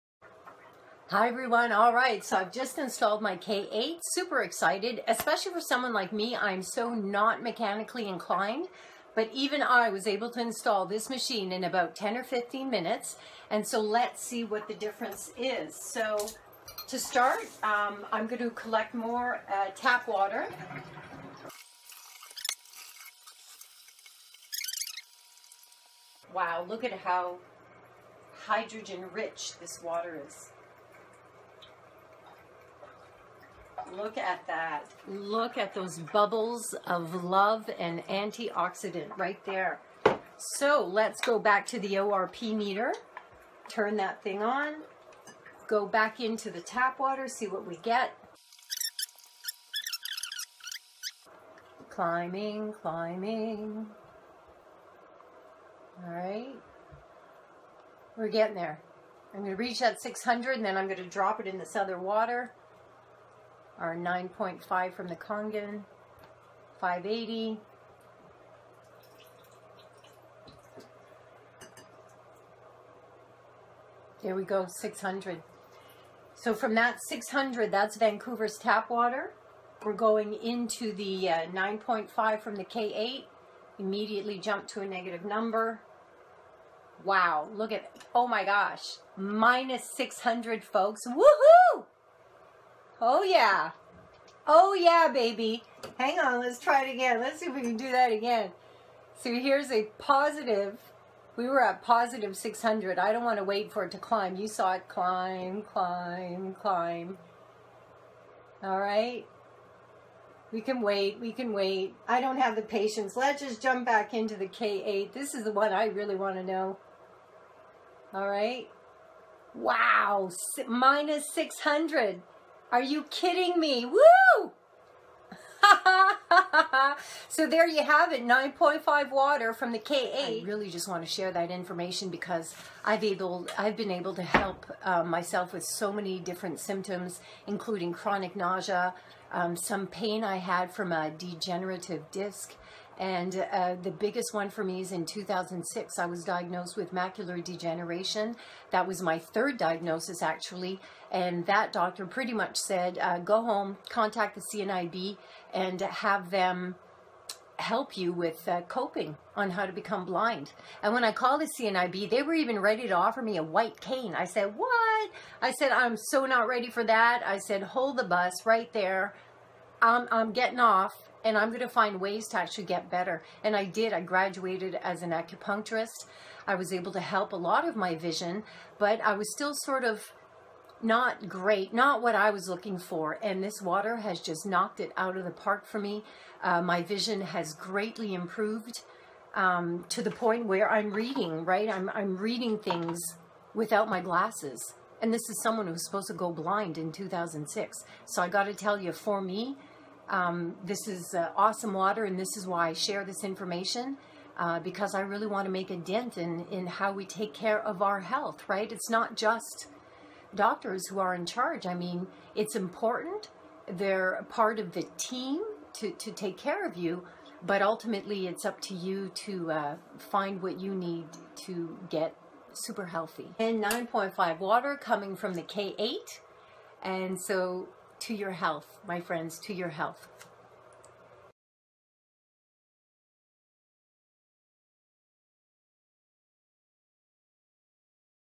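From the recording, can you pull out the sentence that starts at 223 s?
And 9.5 water coming from the K8.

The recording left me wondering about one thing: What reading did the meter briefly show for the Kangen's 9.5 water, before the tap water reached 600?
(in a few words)
580.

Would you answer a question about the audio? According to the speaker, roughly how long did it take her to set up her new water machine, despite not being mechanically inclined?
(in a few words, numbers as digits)
10 or 15 minutes.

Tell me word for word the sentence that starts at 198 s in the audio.
So I got to tell you, for me, um, this is uh, awesome water, and this is why I share this information.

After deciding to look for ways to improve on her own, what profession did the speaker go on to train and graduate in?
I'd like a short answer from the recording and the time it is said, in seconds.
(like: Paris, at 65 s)
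Acupuncturist, at 175 s.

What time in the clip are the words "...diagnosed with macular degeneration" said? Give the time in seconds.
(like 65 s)
146 s.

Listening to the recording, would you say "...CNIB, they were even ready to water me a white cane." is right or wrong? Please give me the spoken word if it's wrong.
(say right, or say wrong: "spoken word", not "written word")
wrong: "offer", not "water".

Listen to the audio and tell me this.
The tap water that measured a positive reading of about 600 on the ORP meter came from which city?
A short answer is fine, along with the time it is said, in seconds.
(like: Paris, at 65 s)
Vancouver, at 77 s.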